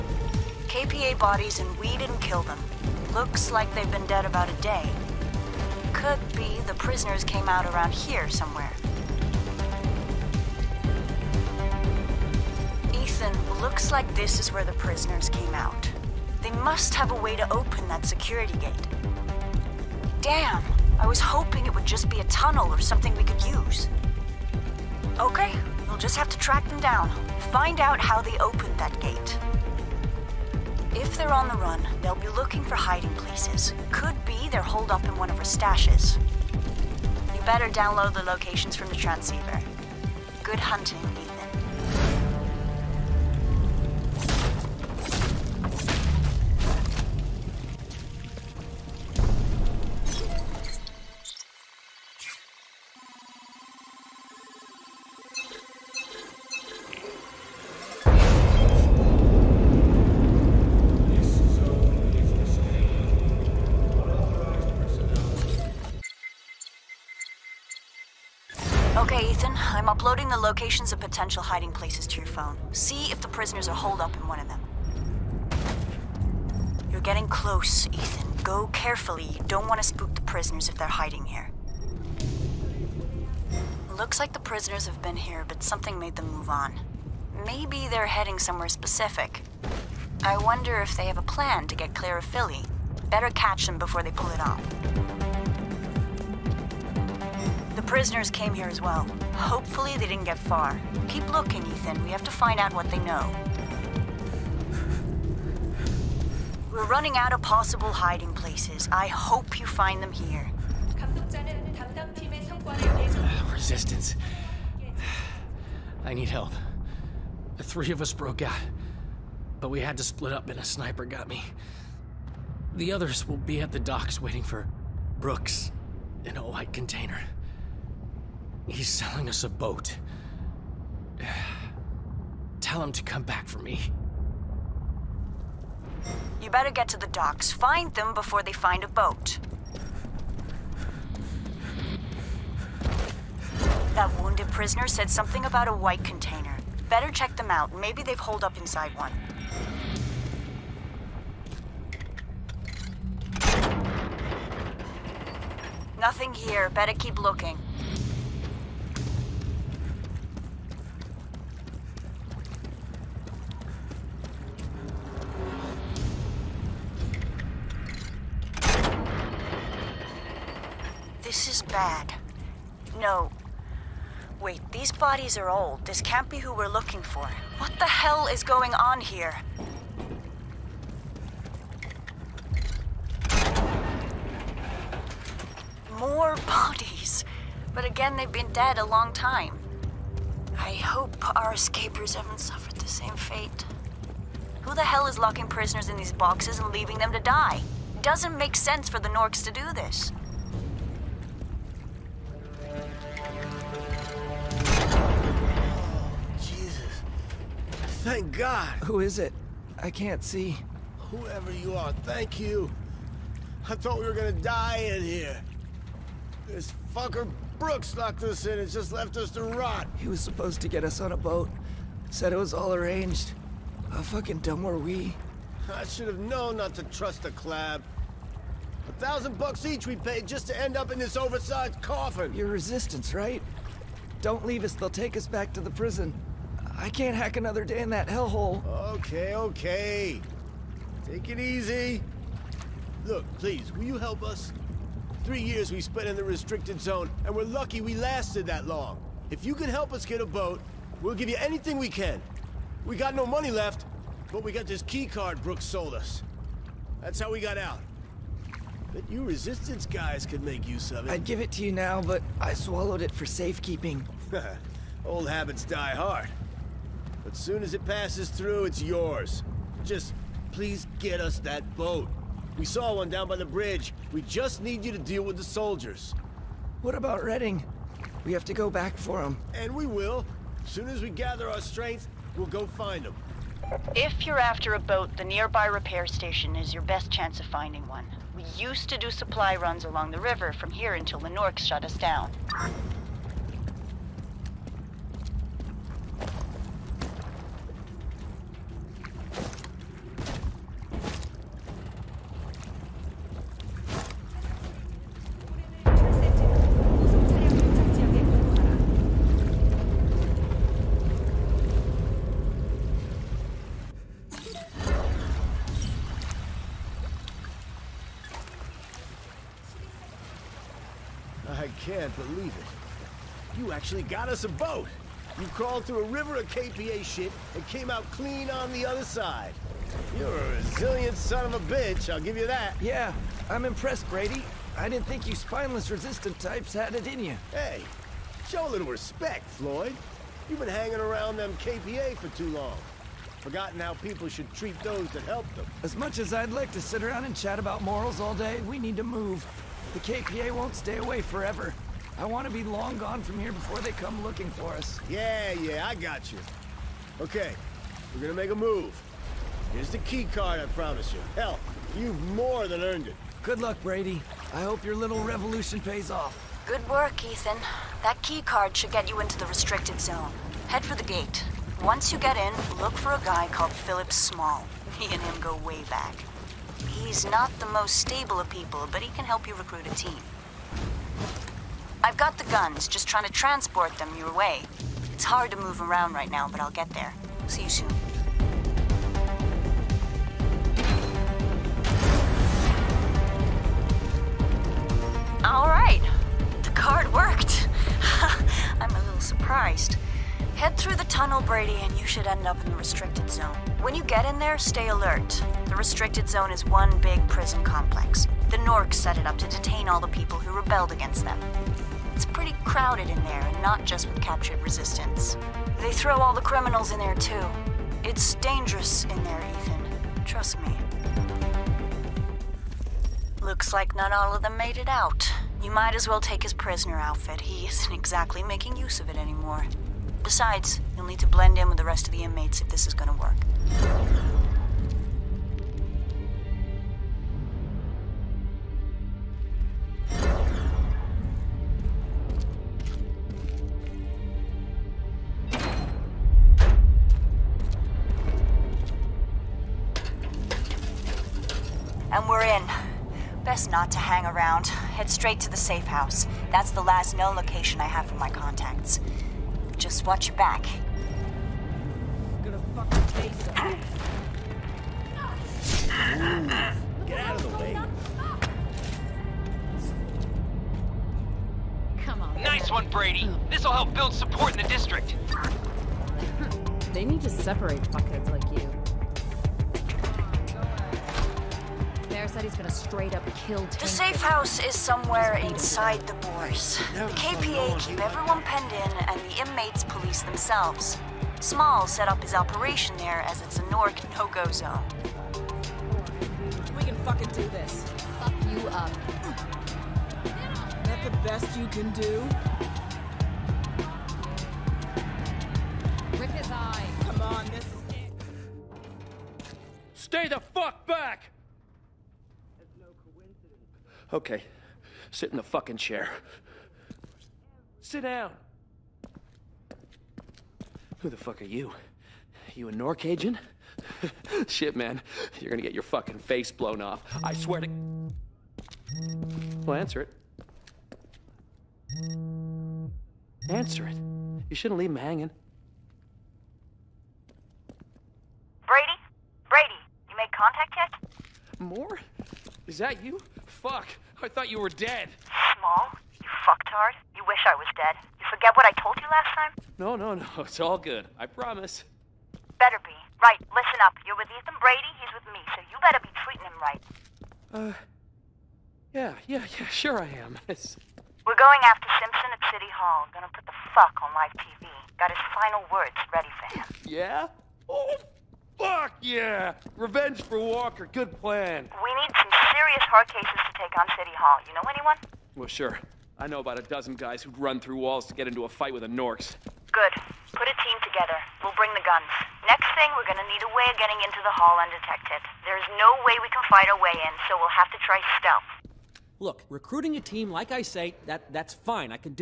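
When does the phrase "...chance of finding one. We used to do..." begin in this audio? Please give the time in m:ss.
4:47.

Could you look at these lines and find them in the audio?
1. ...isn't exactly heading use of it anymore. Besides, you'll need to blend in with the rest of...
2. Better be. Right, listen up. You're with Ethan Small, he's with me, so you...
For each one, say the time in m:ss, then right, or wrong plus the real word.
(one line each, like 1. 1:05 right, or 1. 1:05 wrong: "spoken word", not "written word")
1. 7:07 wrong: "making", not "heading"
2. 9:12 wrong: "Brady", not "Small".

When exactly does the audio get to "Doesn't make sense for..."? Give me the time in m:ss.
3:18.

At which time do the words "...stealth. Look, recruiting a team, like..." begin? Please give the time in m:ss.
9:48.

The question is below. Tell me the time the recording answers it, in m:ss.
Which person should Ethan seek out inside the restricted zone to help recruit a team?
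6:13.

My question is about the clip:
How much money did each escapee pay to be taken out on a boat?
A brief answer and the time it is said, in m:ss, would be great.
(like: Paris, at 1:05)
$1,000 each, at 3:48.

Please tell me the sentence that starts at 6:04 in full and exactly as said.
I hope your little revolution pays off.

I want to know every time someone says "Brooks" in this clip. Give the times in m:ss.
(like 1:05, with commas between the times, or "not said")
2:05, 3:37, 4:15.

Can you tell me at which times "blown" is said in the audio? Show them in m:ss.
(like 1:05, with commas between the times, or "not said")
8:46.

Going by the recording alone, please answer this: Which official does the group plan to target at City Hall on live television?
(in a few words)
Simpson.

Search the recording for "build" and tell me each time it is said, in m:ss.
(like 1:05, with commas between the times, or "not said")
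7:53.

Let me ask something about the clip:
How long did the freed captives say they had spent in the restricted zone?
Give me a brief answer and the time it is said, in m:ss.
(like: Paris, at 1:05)
Three years, at 4:05.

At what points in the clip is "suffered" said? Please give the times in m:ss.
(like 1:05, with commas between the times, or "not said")
3:12.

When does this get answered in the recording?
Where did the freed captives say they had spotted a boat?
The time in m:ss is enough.
4:33.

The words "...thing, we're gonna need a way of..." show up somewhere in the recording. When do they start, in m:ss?
9:42.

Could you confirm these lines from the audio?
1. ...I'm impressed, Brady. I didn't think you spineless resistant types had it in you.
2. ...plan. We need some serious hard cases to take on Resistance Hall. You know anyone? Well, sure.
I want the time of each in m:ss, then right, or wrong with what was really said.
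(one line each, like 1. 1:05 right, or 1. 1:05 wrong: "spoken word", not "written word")
1. 5:33 right
2. 9:31 wrong: "City", not "Resistance".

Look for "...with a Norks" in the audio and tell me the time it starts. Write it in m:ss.
9:38.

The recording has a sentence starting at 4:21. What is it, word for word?
I'd give it to you now, but I swallowed it for safekeeping.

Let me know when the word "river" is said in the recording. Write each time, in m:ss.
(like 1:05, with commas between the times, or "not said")
4:50, 5:26.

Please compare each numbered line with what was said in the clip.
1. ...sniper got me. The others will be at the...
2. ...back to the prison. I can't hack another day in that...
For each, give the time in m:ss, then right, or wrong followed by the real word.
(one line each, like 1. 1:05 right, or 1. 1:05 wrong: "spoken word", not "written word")
1. 2:00 right
2. 3:55 right.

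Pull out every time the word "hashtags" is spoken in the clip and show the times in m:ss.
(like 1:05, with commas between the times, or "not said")
not said.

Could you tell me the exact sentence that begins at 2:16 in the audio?
You better get to the docks.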